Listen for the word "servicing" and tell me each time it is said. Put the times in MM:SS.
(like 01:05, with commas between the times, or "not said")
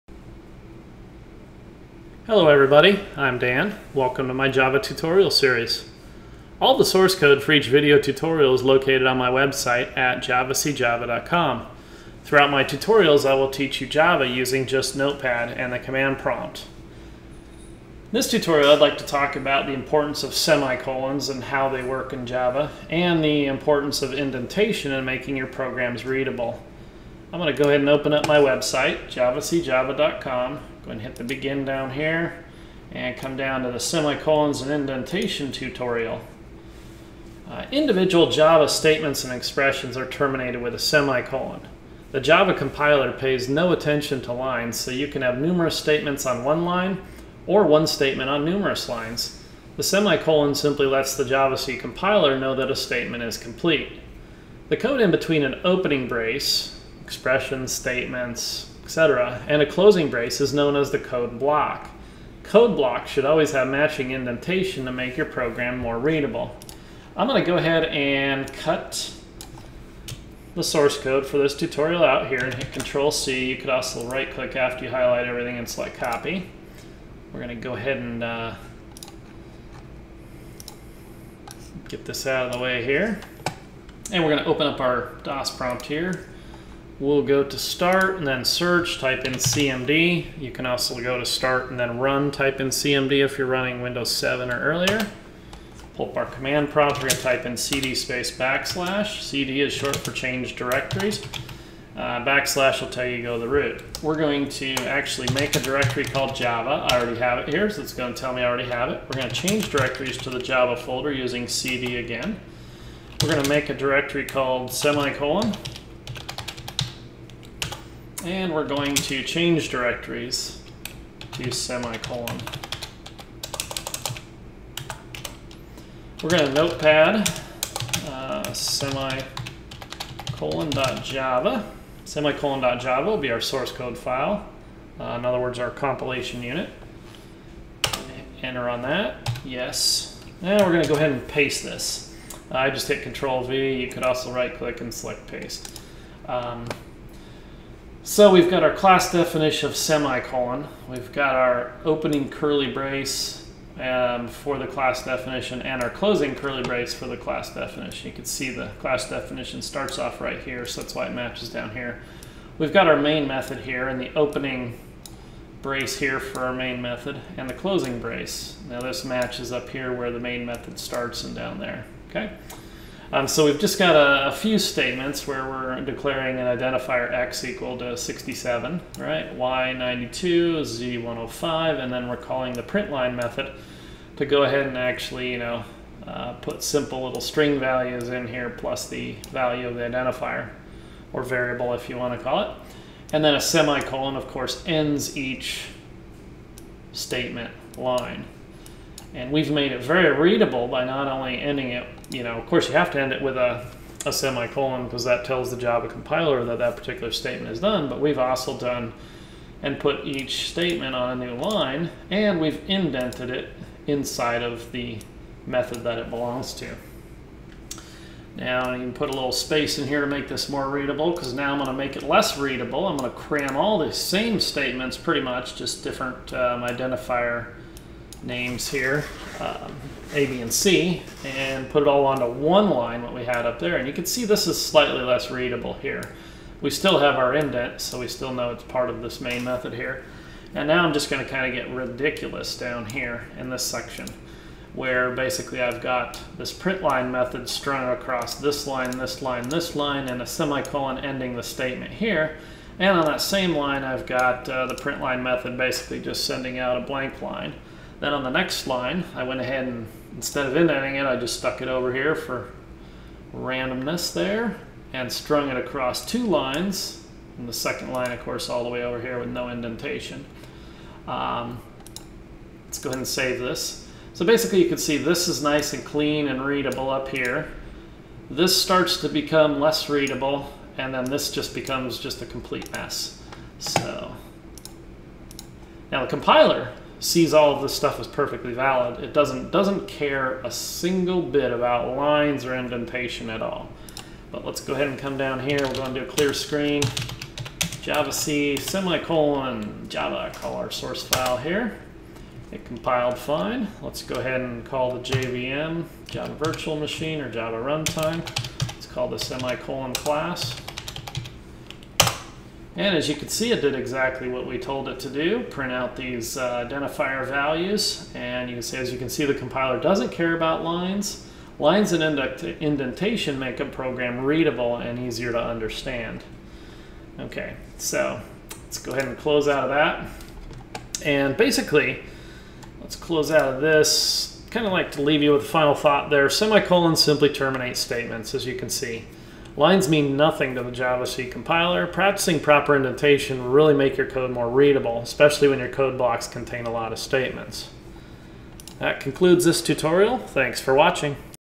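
not said.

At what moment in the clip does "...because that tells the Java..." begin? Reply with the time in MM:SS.
03:24.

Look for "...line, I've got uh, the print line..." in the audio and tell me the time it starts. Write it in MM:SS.
04:13.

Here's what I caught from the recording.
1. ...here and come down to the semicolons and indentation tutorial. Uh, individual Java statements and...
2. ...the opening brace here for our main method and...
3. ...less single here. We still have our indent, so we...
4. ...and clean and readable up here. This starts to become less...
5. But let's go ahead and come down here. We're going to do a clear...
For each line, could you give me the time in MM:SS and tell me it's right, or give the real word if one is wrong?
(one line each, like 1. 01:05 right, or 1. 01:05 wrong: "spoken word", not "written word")
1. 00:31 right
2. 02:44 right
3. 03:55 wrong: "readable", not "single"
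4. 04:35 right
5. 04:54 right.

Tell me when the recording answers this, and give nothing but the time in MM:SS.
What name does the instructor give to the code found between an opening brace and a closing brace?
01:00.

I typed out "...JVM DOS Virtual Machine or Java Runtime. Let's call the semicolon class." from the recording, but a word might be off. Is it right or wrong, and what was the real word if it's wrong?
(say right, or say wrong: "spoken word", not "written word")
wrong: "Java", not "DOS".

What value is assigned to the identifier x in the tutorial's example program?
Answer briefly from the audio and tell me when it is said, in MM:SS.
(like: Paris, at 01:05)
67, at 02:57.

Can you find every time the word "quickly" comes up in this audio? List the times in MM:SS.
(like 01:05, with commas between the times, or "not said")
not said.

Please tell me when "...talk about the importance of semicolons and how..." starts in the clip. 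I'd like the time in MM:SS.
00:19.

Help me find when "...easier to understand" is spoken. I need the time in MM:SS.
05:24.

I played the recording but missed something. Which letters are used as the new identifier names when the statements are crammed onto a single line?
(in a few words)
A, B, and C.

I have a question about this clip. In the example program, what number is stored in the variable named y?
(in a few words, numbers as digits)
92.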